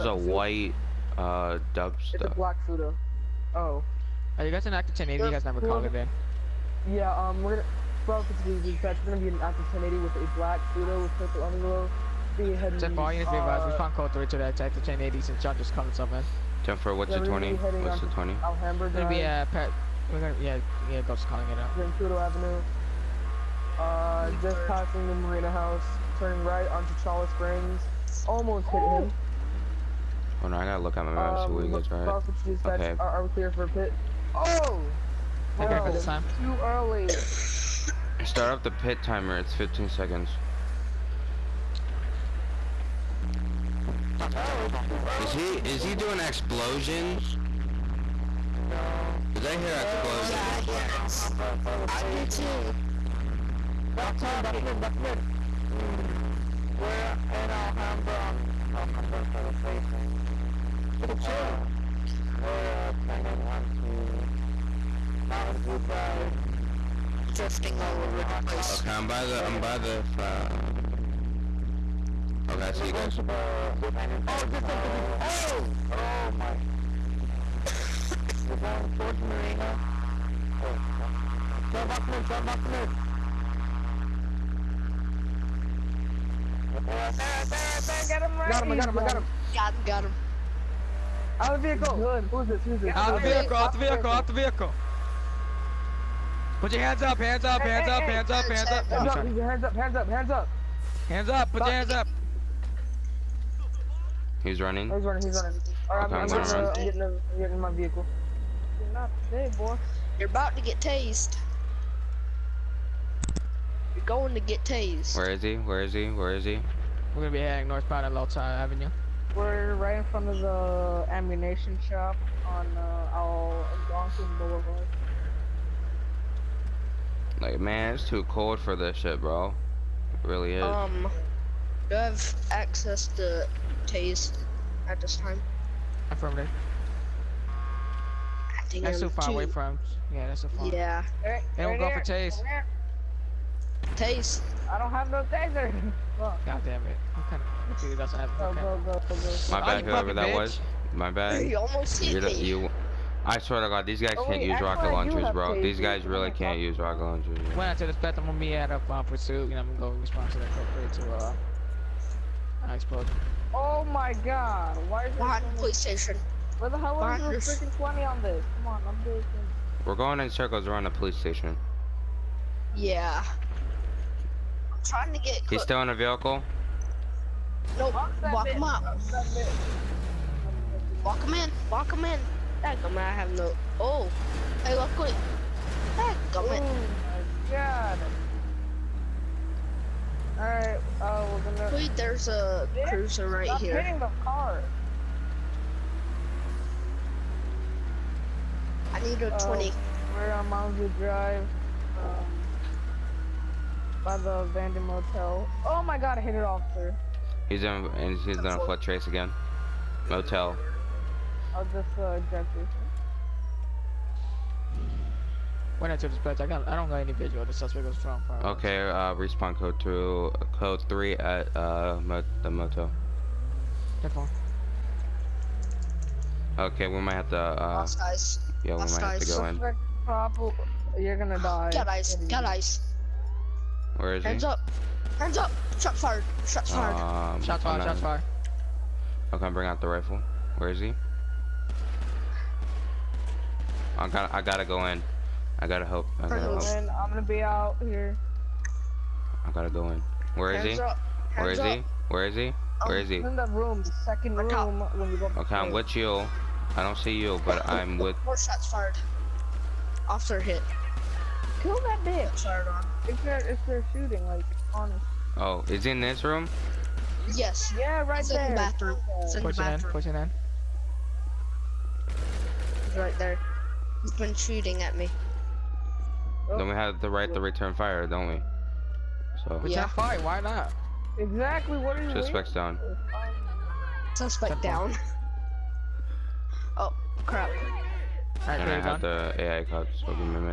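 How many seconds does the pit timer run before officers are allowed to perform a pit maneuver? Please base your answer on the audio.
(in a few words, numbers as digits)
15.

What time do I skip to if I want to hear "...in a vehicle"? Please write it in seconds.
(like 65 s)
175 s.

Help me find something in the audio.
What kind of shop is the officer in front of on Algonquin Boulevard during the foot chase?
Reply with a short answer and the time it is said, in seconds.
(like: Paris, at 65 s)
Ammunition shop, at 121 s.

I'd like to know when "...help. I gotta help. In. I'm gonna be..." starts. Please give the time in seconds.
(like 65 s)
245 s.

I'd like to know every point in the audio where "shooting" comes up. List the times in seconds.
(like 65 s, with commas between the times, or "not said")
263 s, 274 s.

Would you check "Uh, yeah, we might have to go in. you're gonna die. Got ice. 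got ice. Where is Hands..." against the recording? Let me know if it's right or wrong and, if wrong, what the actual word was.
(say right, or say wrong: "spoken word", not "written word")
right.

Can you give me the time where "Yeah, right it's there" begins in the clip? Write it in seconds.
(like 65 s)
267 s.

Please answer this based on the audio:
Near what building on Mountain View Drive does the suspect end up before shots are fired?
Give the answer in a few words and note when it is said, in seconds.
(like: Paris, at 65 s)
Abandoned motel, at 204 s.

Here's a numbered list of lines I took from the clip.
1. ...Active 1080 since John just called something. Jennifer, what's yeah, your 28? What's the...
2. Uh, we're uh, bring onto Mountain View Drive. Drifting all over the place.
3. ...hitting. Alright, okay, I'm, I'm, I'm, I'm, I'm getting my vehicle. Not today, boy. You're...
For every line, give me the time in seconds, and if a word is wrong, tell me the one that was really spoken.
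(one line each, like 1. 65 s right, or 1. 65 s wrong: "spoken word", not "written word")
1. 14 s wrong: "20", not "28"
2. 61 s wrong: "turning", not "bring"
3. 105 s wrong: "running", not "hitting".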